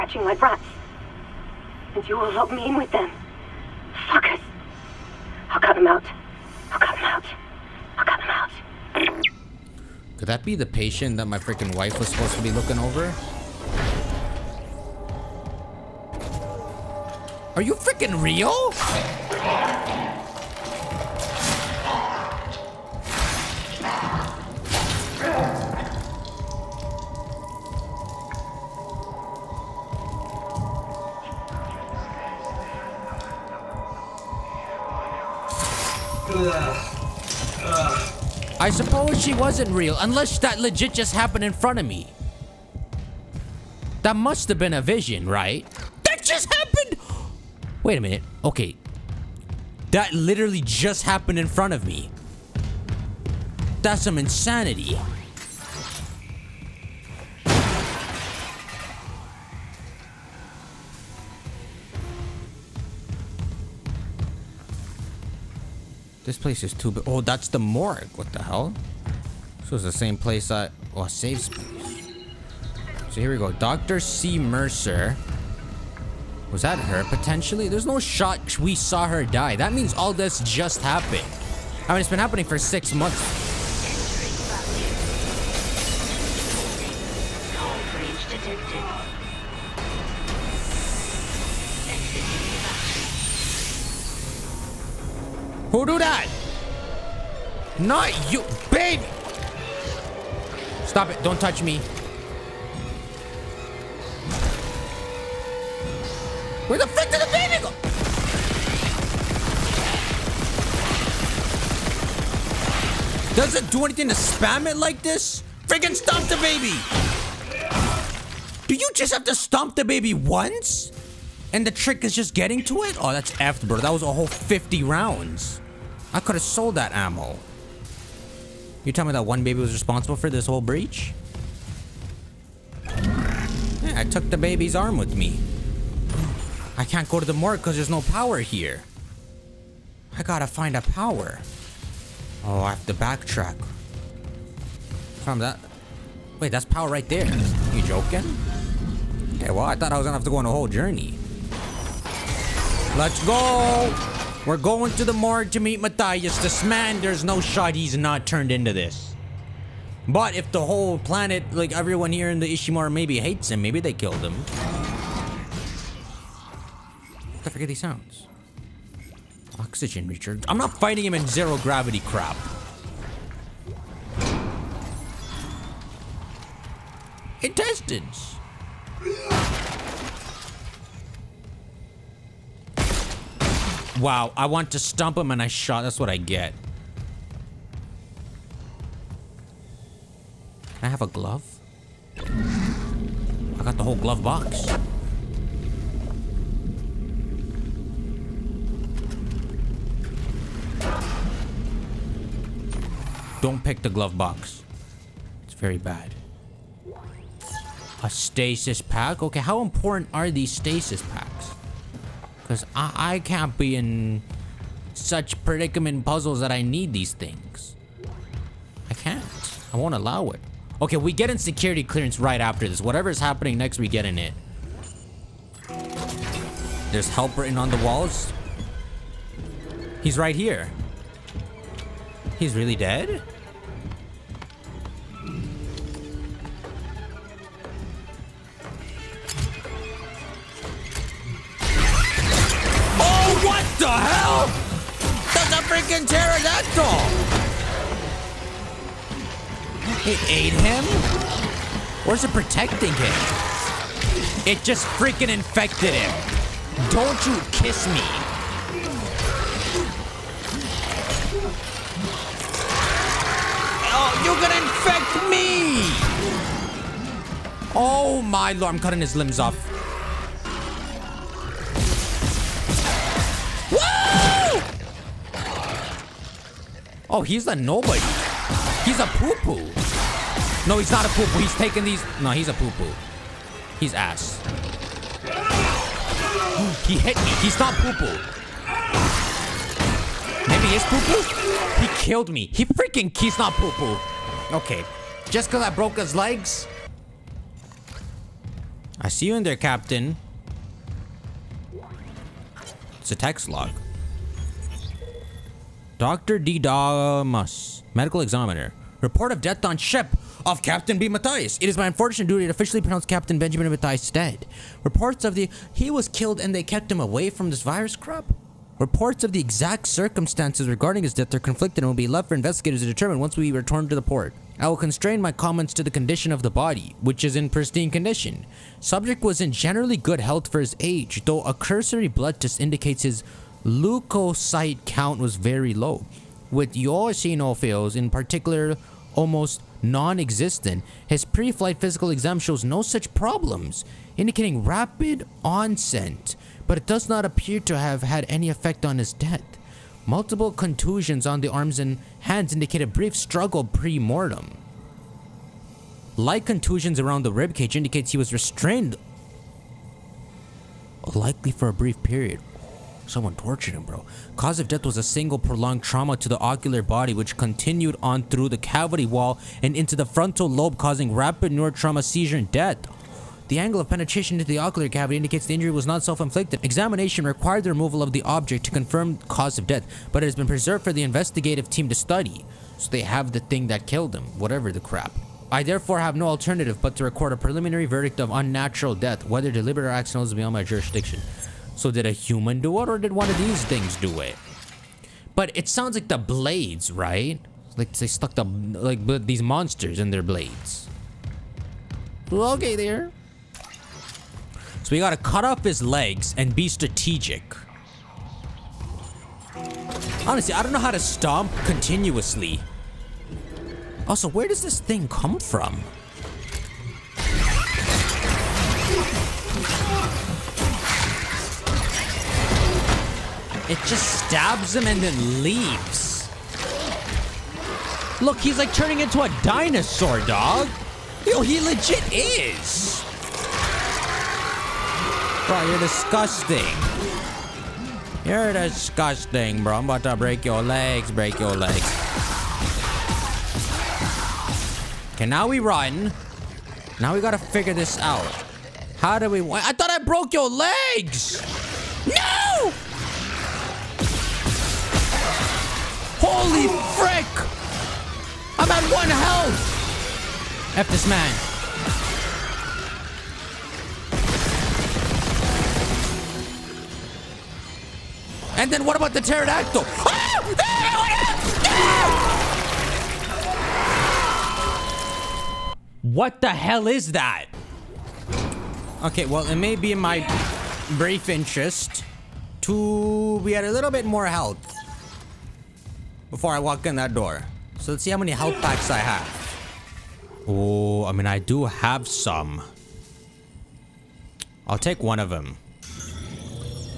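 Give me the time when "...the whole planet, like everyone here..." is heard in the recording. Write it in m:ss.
2:40.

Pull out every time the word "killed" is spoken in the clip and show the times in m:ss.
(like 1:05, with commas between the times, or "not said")
2:43, 4:51, 5:16, 6:23.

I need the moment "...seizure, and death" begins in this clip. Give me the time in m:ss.
6:12.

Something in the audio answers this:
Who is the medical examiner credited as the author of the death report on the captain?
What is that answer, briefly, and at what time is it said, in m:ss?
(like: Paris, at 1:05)
Dr. D. Damas, at 5:05.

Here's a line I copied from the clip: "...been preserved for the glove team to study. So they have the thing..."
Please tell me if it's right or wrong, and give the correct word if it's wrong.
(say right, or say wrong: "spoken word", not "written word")
wrong: "investigative", not "glove".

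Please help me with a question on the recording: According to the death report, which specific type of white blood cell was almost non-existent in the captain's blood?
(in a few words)
eosinophils.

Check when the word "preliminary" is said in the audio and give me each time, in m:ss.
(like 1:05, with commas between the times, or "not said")
6:27.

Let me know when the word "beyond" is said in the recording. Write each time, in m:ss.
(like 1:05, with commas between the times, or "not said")
6:30.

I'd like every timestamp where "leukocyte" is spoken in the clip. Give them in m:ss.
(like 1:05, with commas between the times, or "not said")
5:33.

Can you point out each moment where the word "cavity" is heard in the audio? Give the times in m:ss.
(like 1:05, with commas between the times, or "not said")
6:08, 6:14.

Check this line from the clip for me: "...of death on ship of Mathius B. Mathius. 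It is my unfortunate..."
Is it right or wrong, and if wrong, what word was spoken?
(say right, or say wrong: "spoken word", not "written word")
wrong: "Captain", not "Mathius".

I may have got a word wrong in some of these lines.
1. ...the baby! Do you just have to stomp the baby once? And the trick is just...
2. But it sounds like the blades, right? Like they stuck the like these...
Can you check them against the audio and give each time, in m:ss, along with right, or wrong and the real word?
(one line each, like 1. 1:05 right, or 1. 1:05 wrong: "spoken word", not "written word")
1. 1:56 right
2. 6:35 right.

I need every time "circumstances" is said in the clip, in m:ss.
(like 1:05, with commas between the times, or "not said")
5:19.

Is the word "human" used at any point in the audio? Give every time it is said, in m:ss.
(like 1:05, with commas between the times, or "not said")
6:32.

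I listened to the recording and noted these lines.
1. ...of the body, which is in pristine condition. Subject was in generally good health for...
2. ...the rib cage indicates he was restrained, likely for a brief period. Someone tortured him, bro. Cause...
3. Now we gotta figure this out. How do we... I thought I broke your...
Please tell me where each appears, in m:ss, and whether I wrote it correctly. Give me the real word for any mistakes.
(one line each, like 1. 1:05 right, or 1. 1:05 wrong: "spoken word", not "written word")
1. 5:26 right
2. 5:57 right
3. 7:26 right.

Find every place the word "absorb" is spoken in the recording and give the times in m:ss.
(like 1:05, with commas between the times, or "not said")
not said.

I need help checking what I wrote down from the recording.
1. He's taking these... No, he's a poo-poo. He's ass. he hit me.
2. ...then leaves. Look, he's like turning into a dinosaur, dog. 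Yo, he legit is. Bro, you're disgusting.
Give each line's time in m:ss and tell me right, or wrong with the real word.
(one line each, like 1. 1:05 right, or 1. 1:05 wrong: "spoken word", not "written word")
1. 4:41 right
2. 7:05 right.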